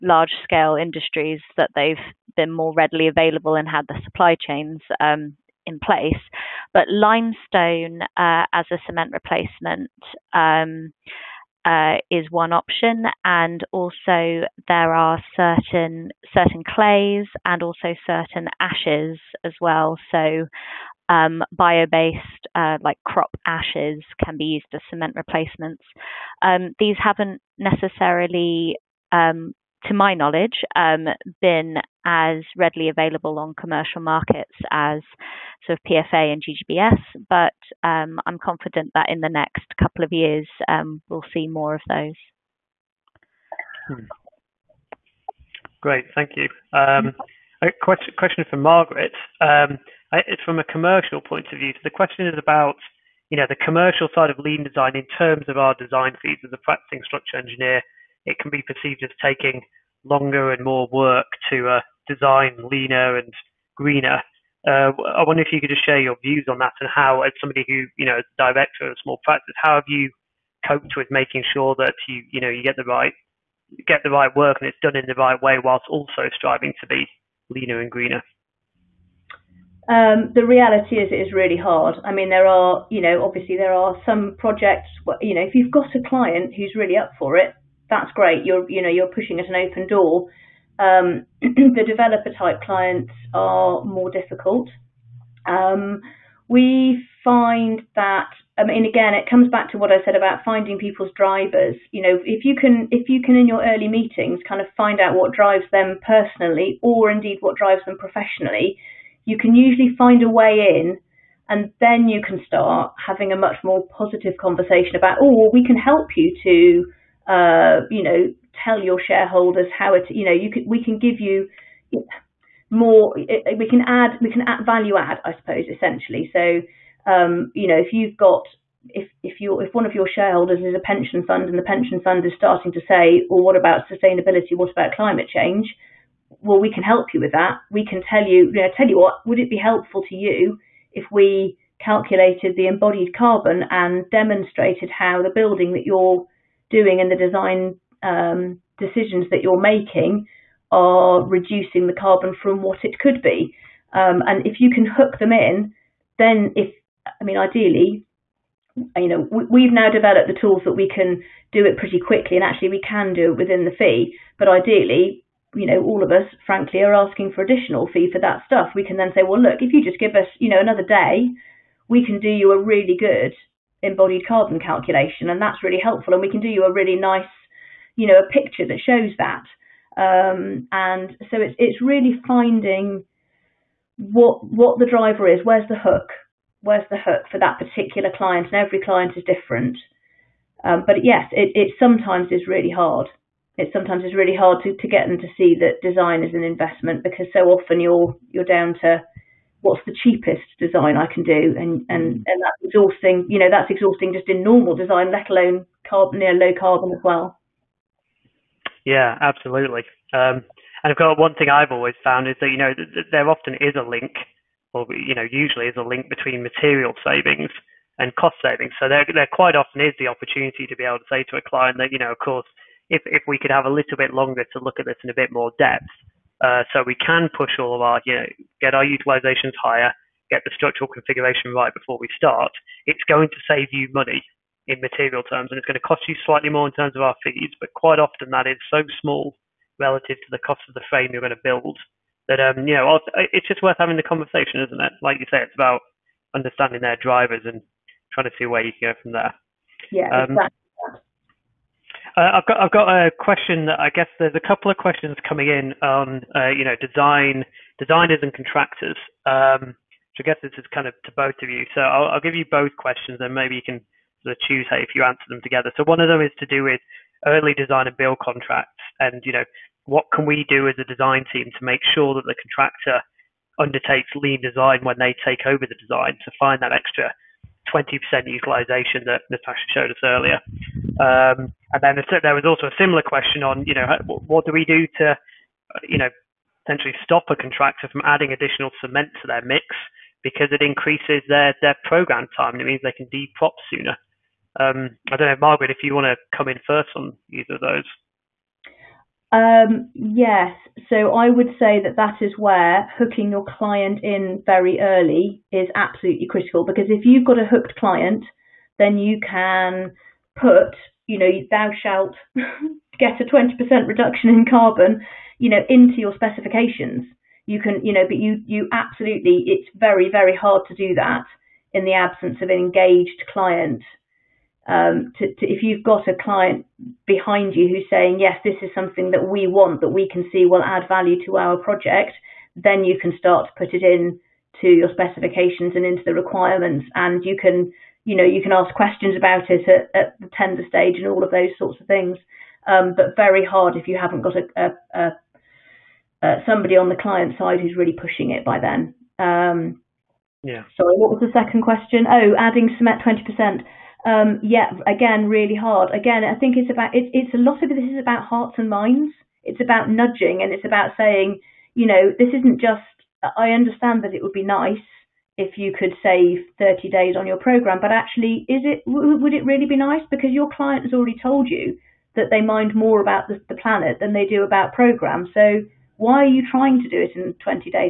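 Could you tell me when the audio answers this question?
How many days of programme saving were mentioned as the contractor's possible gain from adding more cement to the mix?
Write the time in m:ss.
6:06.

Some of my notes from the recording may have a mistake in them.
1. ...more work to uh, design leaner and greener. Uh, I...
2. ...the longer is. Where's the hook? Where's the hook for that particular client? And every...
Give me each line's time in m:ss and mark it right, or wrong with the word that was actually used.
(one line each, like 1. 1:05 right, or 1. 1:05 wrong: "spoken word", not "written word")
1. 1:00 right
2. 3:04 wrong: "driver", not "longer".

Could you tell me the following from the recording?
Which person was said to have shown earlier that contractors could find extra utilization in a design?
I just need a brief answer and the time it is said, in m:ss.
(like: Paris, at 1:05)
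Natasha, at 4:39.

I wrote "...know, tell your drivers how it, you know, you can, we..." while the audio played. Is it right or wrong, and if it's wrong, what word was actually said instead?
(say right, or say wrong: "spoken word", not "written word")
wrong: "shareholders", not "drivers".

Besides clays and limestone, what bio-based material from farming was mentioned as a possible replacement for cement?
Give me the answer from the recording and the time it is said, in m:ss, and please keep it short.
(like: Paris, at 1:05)
Crop ashes, at 0:23.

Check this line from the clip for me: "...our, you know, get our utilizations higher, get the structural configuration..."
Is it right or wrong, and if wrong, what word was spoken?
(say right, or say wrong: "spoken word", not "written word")
right.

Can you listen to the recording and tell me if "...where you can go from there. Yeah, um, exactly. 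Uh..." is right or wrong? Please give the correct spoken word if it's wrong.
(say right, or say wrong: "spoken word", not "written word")
right.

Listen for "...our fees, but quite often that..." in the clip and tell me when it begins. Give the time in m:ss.
3:57.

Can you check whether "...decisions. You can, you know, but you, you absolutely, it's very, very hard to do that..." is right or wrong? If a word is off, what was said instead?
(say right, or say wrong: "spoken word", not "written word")
wrong: "specifications", not "decisions".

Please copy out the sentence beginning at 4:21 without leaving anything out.
So I'll, I'll, give you both questions, and maybe you can sort of choose how if you answer them together.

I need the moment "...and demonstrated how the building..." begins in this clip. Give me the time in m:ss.
2:23.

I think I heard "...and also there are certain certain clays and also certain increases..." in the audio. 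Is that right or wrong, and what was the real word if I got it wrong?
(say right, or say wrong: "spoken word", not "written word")
wrong: "ashes", not "increases".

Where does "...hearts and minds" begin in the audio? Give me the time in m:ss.
5:58.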